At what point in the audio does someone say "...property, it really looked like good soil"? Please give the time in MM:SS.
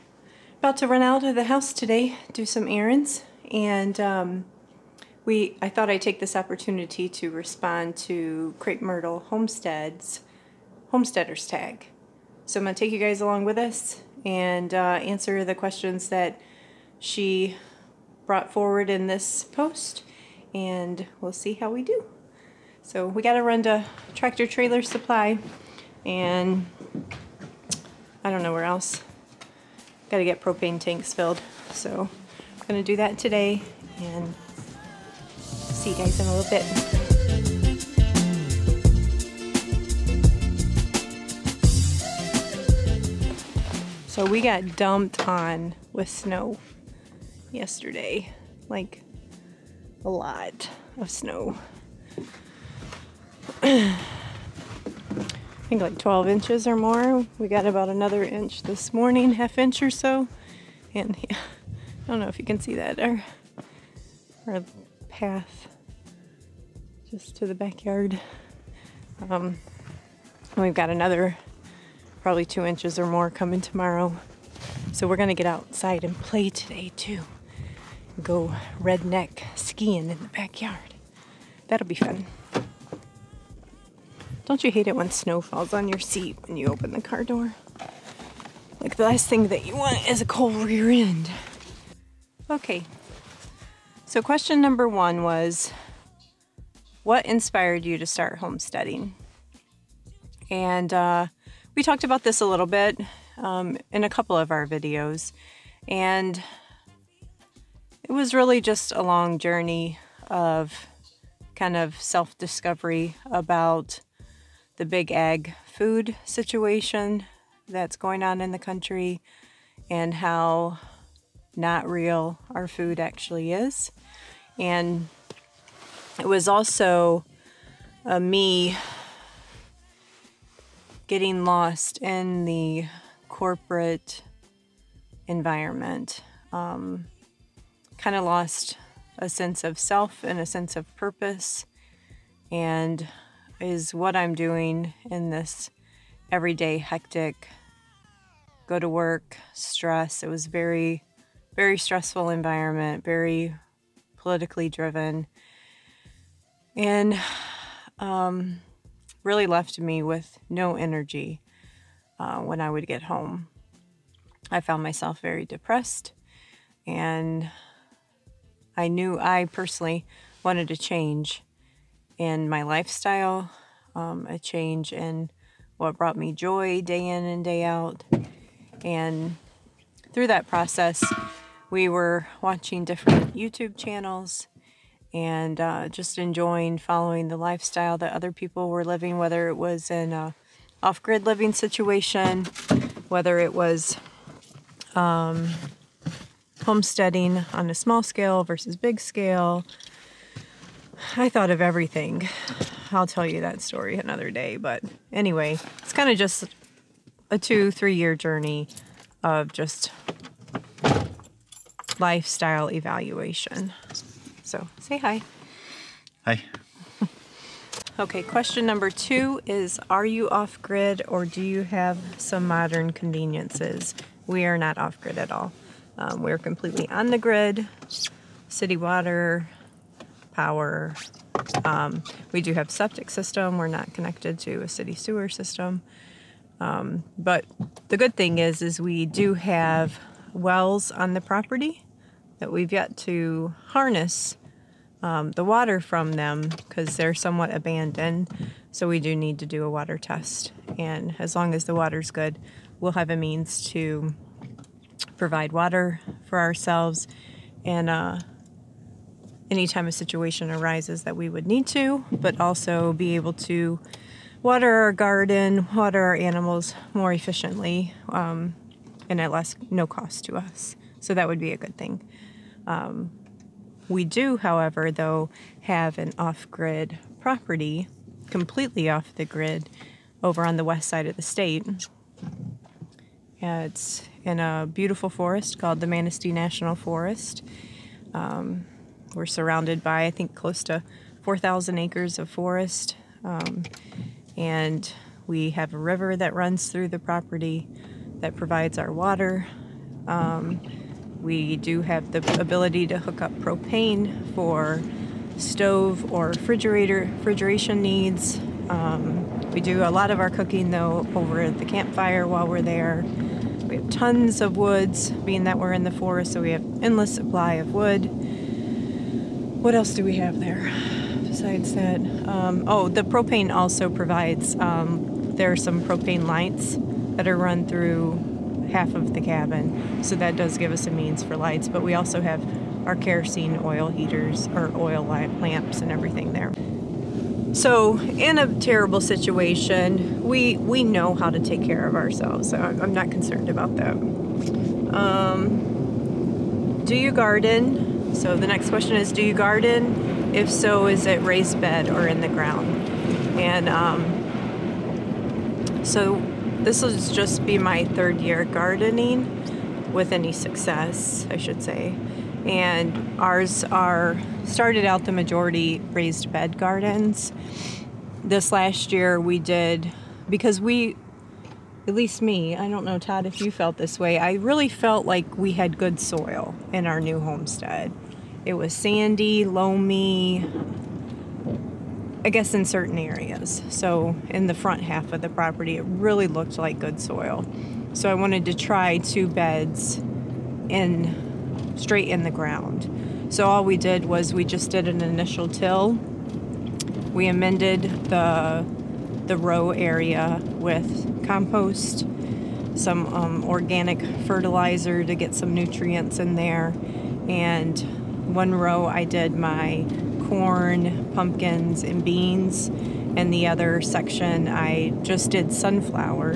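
06:25.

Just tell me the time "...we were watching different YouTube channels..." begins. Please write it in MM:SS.
03:01.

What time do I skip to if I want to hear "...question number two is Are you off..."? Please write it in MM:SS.
03:38.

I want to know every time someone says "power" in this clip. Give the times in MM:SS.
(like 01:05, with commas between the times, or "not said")
03:50.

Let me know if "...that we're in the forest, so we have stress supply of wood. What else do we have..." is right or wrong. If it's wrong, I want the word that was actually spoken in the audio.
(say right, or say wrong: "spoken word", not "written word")
wrong: "endless", not "stress".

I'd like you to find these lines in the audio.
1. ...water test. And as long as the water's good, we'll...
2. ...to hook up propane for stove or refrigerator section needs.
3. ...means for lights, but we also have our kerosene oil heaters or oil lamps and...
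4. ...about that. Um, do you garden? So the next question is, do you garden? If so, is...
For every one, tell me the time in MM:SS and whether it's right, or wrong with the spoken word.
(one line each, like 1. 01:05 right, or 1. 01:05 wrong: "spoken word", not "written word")
1. 04:09 right
2. 05:02 wrong: "refrigeration", not "section"
3. 05:30 right
4. 05:43 right.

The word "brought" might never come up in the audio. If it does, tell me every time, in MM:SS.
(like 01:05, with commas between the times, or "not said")
00:18, 02:55.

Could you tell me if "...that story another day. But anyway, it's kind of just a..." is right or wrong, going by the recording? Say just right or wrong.
right.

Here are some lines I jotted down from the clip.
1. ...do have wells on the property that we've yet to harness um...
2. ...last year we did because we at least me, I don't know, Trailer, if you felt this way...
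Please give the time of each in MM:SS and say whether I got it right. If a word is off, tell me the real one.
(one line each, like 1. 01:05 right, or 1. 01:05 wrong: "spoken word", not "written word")
1. 03:59 right
2. 06:08 wrong: "Todd", not "Trailer".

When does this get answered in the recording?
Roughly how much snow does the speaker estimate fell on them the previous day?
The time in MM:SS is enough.
00:55.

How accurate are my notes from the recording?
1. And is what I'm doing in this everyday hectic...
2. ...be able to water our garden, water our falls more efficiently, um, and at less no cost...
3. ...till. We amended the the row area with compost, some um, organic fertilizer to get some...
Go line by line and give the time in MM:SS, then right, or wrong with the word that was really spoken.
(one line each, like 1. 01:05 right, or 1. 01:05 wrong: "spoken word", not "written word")
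1. 02:22 right
2. 04:22 wrong: "animals", not "falls"
3. 06:35 right.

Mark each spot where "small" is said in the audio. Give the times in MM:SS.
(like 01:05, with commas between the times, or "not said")
03:17.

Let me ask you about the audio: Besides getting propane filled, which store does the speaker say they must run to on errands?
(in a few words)
Tractor Trailer Supply.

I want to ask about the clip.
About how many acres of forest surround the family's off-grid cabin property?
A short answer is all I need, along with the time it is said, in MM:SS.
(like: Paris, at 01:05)
4,000 acres, at 04:51.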